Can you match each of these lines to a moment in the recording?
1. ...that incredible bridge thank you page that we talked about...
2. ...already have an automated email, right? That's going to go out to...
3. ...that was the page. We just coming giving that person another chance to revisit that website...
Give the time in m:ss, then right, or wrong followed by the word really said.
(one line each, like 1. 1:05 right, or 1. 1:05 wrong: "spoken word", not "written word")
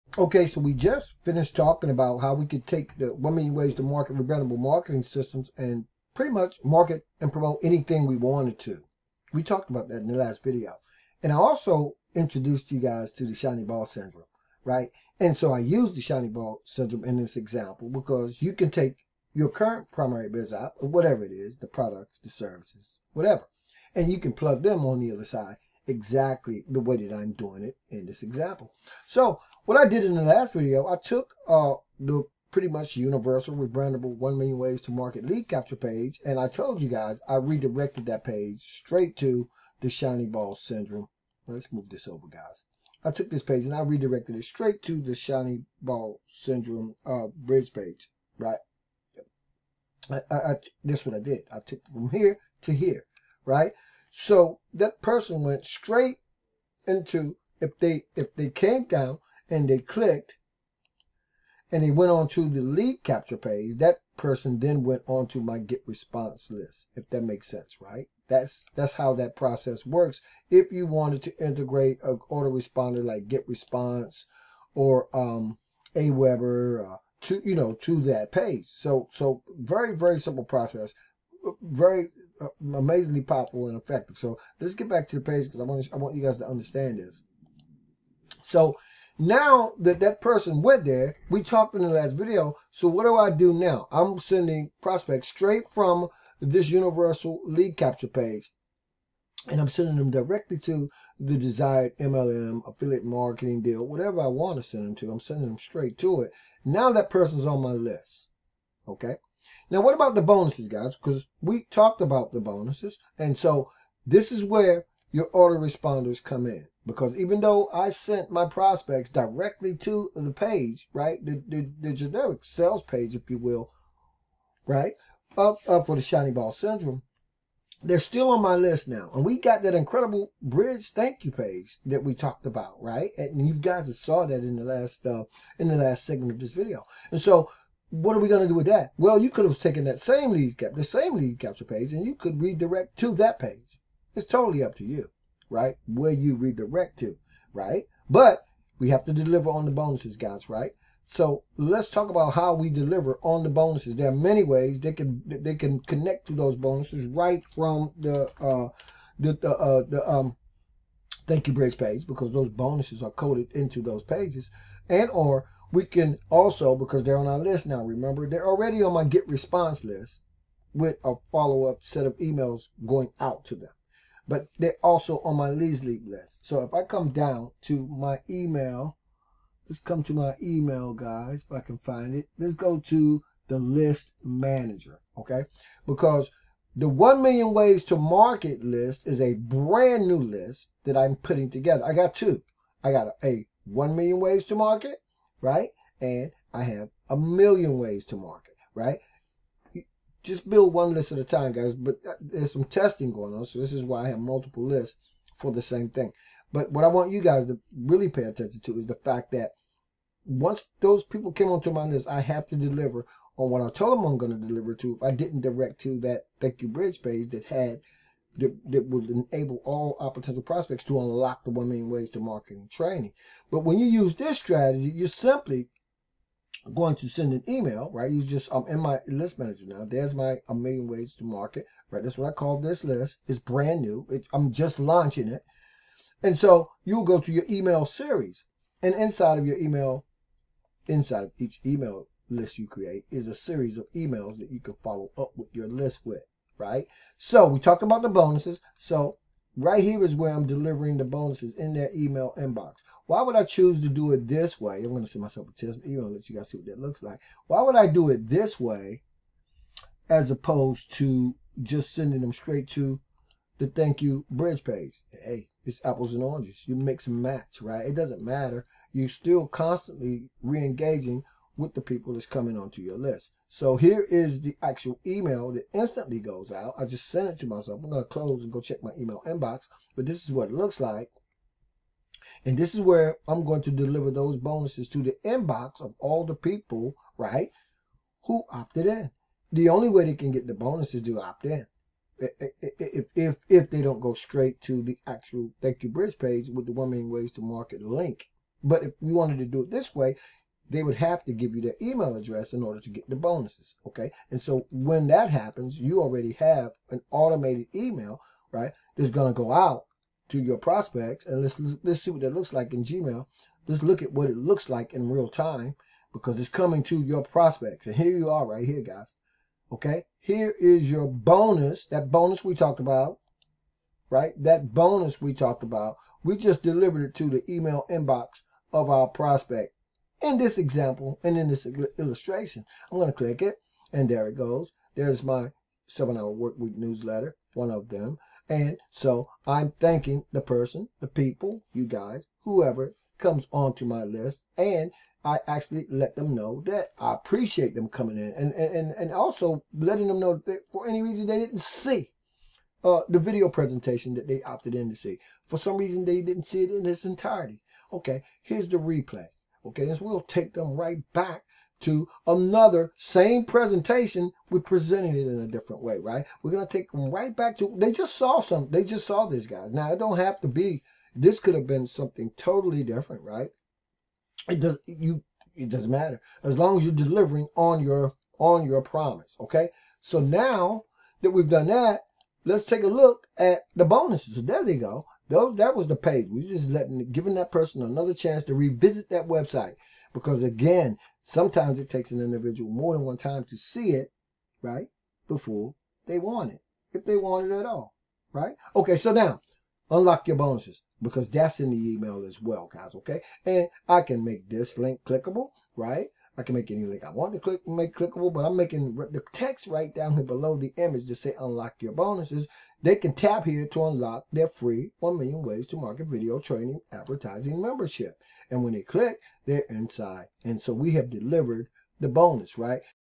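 1. 2:09 right
2. 5:06 right
3. 6:25 wrong: "letting", not "coming".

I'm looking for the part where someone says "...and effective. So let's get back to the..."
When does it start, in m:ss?
1:23.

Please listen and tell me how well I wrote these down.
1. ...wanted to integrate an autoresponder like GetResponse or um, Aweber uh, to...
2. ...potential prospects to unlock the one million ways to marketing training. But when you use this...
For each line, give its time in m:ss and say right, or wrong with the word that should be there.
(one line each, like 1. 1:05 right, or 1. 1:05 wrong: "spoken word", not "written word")
1. 1:10 right
2. 3:40 right.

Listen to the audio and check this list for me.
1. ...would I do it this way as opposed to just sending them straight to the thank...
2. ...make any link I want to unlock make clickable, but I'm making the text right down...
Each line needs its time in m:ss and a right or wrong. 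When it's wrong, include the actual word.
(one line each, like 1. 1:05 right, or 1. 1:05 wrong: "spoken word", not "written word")
1. 4:17 right
2. 6:46 wrong: "click", not "unlock".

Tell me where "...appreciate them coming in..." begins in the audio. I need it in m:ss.
5:47.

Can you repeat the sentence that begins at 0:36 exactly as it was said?
And I told you guys, I redirected that page straight to the shiny ball syndrome.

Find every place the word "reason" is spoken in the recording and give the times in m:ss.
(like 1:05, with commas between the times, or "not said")
5:51, 5:55.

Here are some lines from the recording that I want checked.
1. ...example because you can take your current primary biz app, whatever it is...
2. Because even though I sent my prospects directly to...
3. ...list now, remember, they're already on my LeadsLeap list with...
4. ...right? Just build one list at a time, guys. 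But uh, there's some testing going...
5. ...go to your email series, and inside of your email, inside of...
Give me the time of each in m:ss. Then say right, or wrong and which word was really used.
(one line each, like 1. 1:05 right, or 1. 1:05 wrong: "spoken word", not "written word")
1. 0:17 right
2. 1:56 right
3. 2:47 wrong: "GetResponse", not "LeadsLeap"
4. 3:18 right
5. 3:57 right.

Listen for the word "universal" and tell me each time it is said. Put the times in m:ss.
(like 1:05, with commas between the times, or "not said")
0:32, 1:36.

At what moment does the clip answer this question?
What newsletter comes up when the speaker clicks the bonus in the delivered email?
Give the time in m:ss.
5:35.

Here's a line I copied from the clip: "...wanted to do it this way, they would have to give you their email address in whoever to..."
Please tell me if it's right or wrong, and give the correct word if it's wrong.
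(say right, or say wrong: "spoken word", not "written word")
wrong: "order", not "whoever".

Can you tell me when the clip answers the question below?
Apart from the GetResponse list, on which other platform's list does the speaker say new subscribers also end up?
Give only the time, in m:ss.
2:55.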